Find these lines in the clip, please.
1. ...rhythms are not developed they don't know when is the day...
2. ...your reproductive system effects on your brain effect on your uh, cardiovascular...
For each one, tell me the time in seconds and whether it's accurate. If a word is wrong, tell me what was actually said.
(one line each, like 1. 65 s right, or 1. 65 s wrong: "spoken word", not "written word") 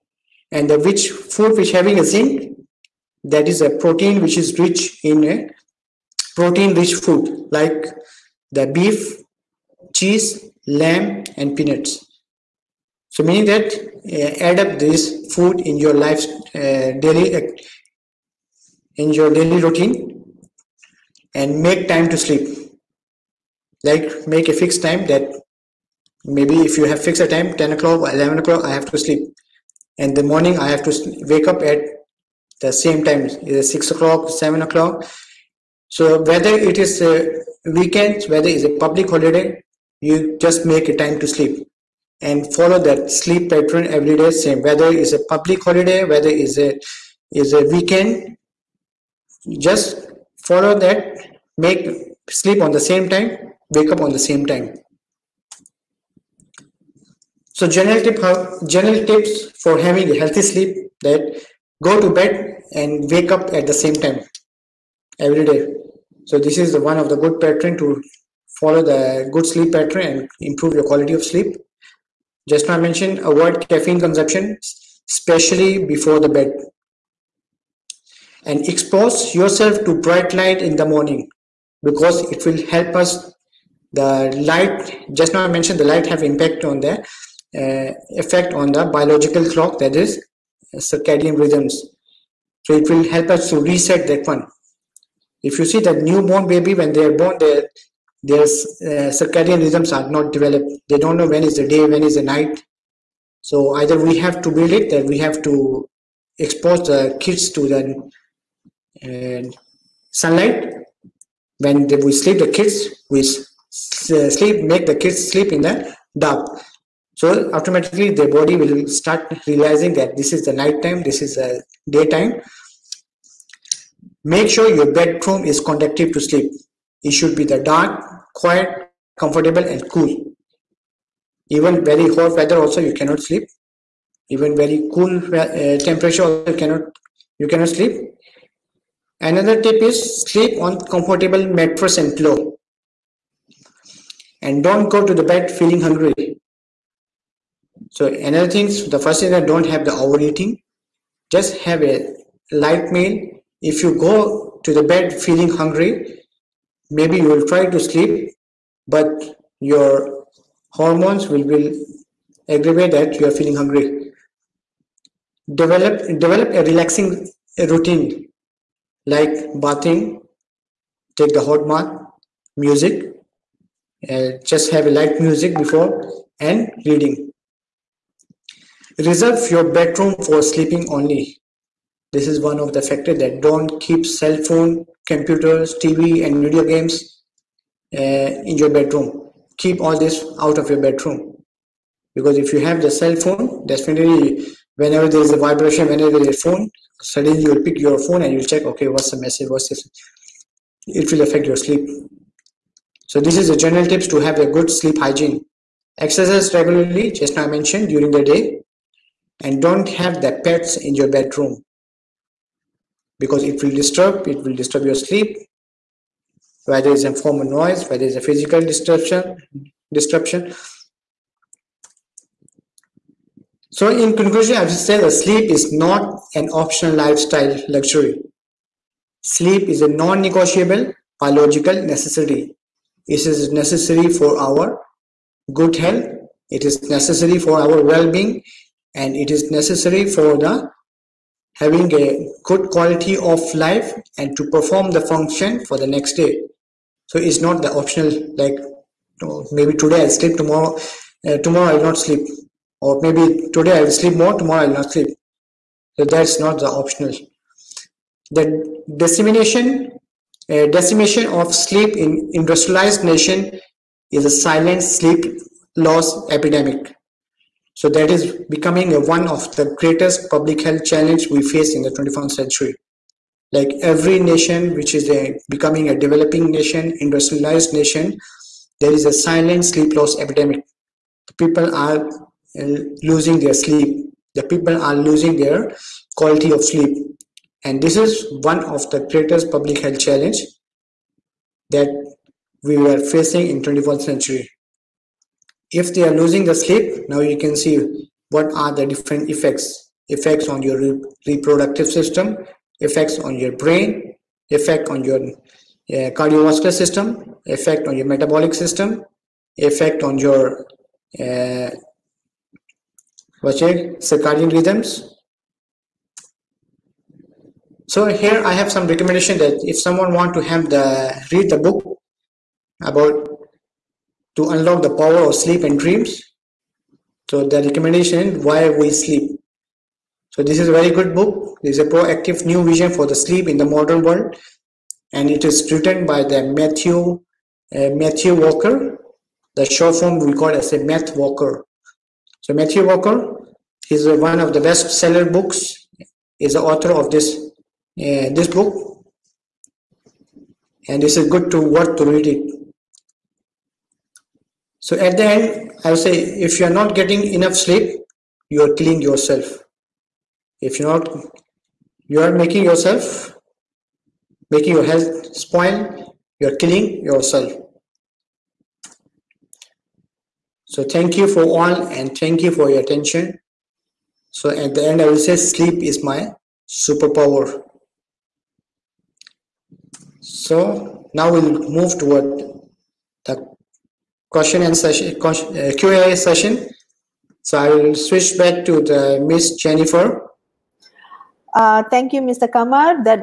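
1. 99 s right
2. 300 s right.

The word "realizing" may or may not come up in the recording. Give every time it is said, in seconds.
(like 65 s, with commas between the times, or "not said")
119 s.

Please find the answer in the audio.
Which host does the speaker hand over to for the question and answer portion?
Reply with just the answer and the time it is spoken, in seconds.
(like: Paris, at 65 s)
Jennifer, at 389 s.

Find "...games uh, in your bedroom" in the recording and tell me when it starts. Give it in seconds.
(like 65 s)
186 s.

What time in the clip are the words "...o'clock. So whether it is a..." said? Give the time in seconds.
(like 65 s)
34 s.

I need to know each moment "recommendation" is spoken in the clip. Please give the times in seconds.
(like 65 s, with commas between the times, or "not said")
318 s, 327 s.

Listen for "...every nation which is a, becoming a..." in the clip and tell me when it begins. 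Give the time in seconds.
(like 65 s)
273 s.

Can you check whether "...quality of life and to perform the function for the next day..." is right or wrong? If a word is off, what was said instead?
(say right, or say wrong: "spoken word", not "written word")
right.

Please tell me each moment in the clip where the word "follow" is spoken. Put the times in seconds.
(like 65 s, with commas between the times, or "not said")
42 s, 50 s, 68 s.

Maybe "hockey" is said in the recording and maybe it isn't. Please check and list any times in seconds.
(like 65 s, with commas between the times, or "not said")
not said.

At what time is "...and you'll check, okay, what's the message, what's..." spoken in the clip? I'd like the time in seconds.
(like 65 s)
198 s.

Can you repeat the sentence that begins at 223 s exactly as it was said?
So in conclusion, I would say that sleep is not an optional lifestyle luxury.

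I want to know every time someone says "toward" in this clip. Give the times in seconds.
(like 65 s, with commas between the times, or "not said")
381 s.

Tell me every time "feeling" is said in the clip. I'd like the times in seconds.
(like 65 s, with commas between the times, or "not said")
145 s, 155 s, 163 s.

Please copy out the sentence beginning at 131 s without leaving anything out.
Even very hot weather also you cannot sleep.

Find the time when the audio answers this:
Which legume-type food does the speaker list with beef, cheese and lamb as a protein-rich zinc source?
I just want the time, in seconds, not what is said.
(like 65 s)
11 s.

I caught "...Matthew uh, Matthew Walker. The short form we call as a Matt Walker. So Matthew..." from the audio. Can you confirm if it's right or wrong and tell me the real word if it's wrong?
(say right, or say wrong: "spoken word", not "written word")
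right.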